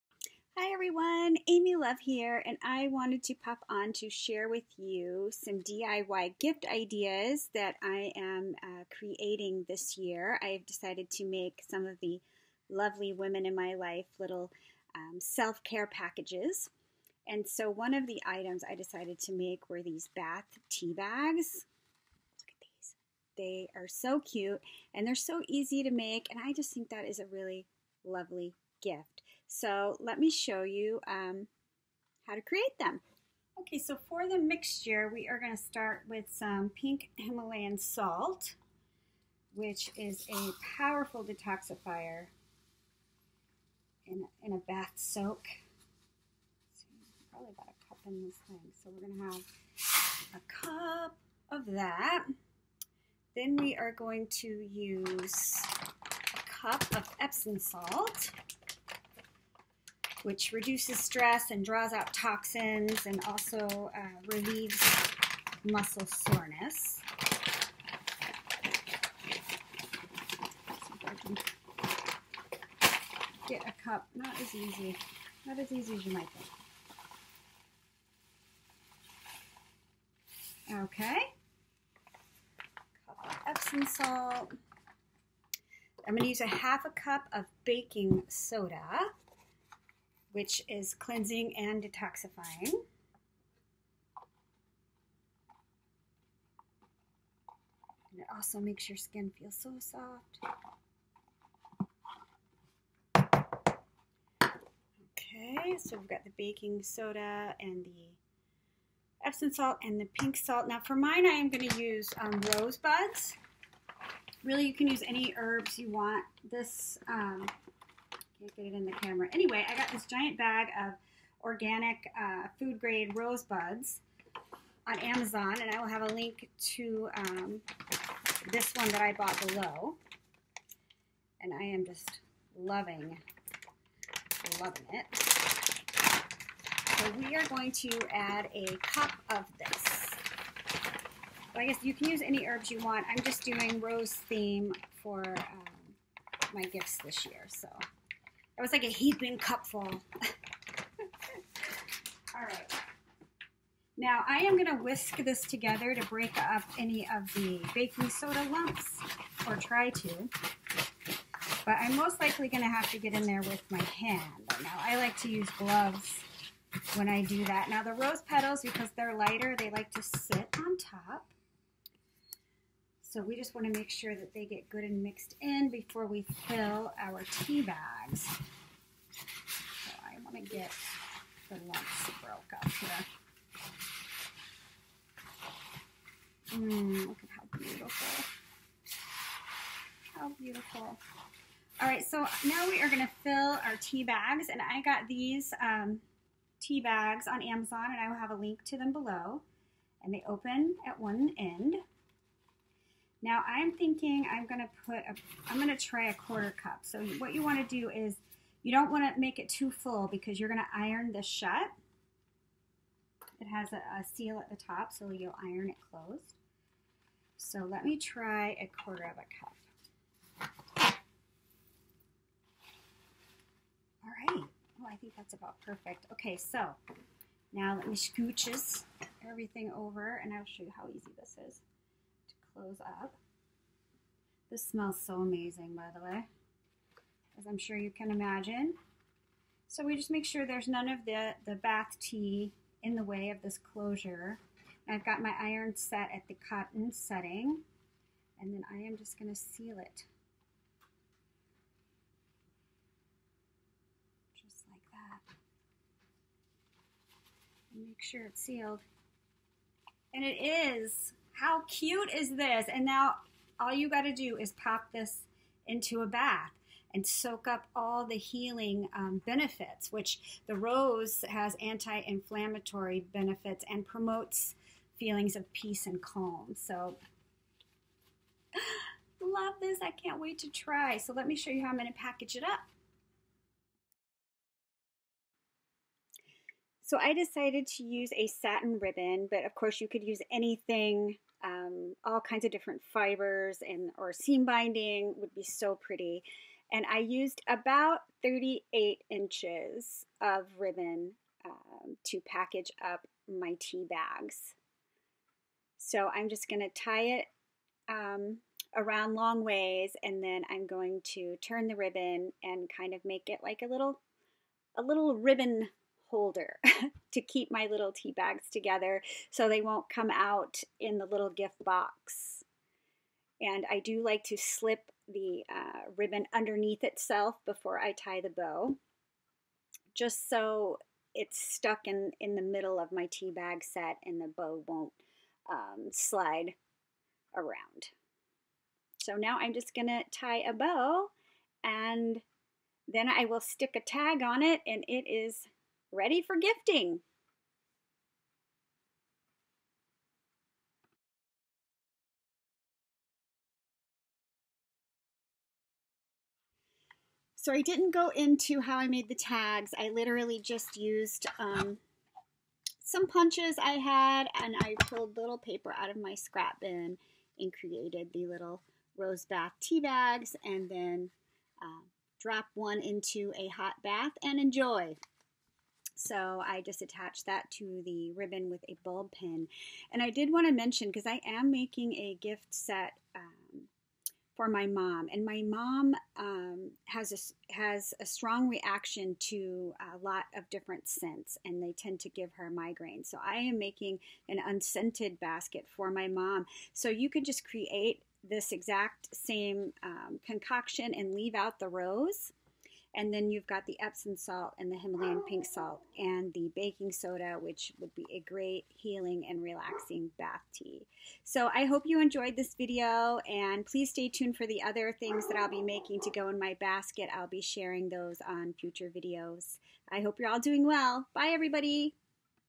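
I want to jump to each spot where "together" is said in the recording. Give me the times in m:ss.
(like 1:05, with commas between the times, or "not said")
2:35, 5:18.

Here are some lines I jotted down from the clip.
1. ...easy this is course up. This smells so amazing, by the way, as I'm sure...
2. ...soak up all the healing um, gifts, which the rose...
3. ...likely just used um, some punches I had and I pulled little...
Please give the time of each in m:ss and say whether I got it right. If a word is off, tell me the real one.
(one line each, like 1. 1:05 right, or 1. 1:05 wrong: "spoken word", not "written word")
1. 3:50 wrong: "close", not "course"
2. 4:27 wrong: "benefits", not "gifts"
3. 5:59 wrong: "literally", not "likely".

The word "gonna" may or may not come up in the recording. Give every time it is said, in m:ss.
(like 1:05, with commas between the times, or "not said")
2:34, 2:42, 4:09.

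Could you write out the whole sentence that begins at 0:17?
And so, one of the items I decided to make were these bath tea bags.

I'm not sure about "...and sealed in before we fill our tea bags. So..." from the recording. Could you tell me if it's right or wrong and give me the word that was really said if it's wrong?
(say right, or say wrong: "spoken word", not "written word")
wrong: "mixed", not "sealed".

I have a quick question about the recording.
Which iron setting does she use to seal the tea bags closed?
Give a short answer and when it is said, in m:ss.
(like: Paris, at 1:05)
cotton, at 4:06.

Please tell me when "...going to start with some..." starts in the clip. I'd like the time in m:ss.
0:35.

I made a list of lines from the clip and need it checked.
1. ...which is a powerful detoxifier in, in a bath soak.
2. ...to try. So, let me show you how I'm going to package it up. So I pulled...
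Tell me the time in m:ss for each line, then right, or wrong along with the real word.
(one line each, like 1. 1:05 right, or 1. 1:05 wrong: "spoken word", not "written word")
1. 0:39 right
2. 4:40 wrong: "decided", not "pulled".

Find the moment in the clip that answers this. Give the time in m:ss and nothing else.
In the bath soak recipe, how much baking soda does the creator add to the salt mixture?
1:26.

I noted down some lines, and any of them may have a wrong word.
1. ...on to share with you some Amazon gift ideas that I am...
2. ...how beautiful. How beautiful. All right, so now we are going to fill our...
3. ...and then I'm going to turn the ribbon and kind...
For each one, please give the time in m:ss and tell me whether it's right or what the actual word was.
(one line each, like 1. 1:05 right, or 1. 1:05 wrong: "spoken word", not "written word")
1. 0:03 wrong: "DIY", not "Amazon"
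2. 3:07 right
3. 5:10 right.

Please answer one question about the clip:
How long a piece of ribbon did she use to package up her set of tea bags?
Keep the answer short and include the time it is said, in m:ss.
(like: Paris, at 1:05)
38 inches, at 4:58.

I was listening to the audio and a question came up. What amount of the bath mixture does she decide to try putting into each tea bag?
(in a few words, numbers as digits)
a quarter cup.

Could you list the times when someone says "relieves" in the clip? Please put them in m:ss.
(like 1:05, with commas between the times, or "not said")
1:04.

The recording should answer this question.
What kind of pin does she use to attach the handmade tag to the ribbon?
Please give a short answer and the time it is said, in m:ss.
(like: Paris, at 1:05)
bulb pin, at 6:18.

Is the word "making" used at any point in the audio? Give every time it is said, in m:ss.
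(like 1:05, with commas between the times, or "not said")
6:21, 6:33, 6:55.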